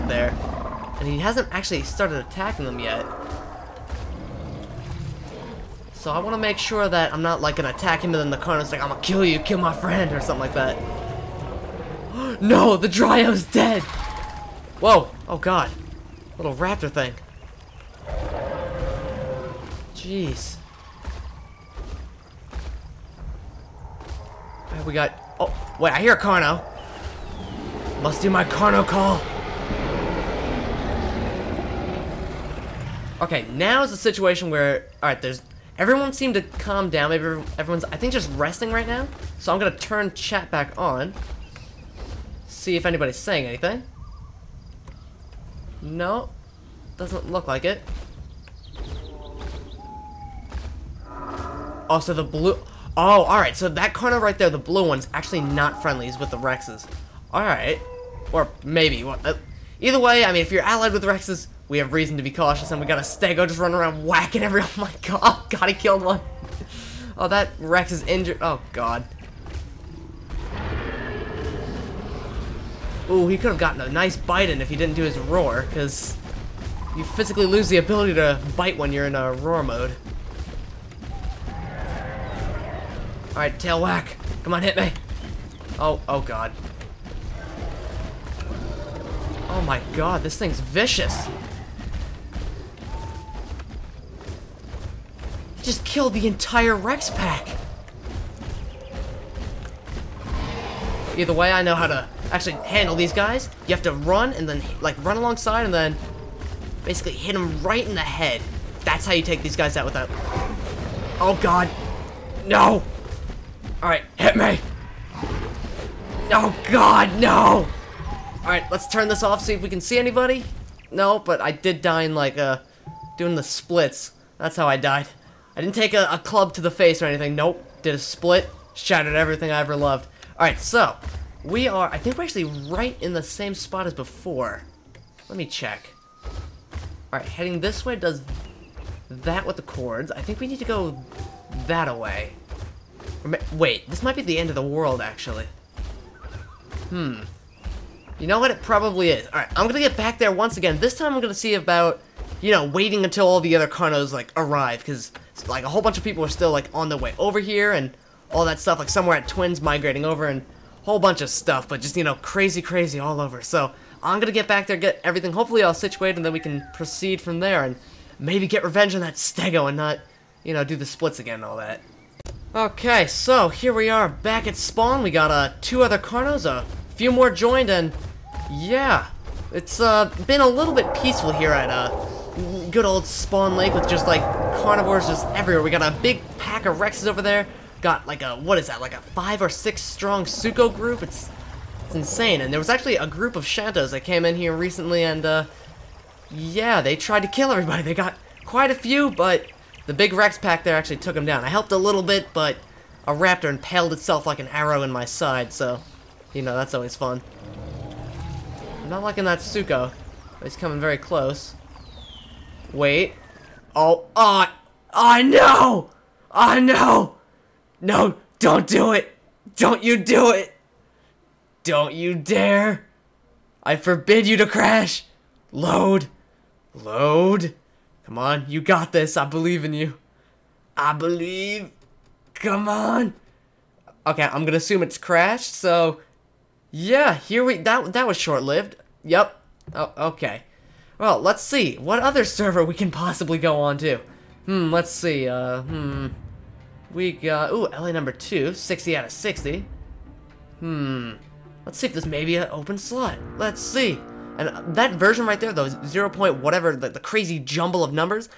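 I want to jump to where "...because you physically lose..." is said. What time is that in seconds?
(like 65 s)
75 s.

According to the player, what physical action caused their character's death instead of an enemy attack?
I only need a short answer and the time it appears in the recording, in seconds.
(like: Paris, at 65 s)
Doing the splits, at 123 s.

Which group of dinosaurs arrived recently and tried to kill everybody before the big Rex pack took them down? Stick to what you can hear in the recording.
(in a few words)
Shantos.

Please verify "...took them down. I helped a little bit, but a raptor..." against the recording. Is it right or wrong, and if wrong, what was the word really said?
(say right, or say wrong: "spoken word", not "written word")
right.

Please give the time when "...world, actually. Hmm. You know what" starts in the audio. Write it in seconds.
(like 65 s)
144 s.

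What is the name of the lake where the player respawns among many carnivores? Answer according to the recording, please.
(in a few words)
Spawn Lake.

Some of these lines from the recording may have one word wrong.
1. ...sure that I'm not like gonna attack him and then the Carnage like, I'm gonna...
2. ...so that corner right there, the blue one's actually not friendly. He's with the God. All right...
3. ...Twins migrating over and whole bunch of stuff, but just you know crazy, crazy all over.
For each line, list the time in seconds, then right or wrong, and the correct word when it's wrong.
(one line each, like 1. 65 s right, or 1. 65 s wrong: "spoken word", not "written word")
1. 6 s right
2. 53 s wrong: "Rexes", not "God"
3. 159 s right.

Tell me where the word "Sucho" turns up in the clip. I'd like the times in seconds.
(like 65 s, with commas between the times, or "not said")
190 s, 209 s.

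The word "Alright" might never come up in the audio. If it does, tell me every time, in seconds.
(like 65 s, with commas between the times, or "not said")
83 s, 113 s, 118 s, 130 s, 137 s, 149 s.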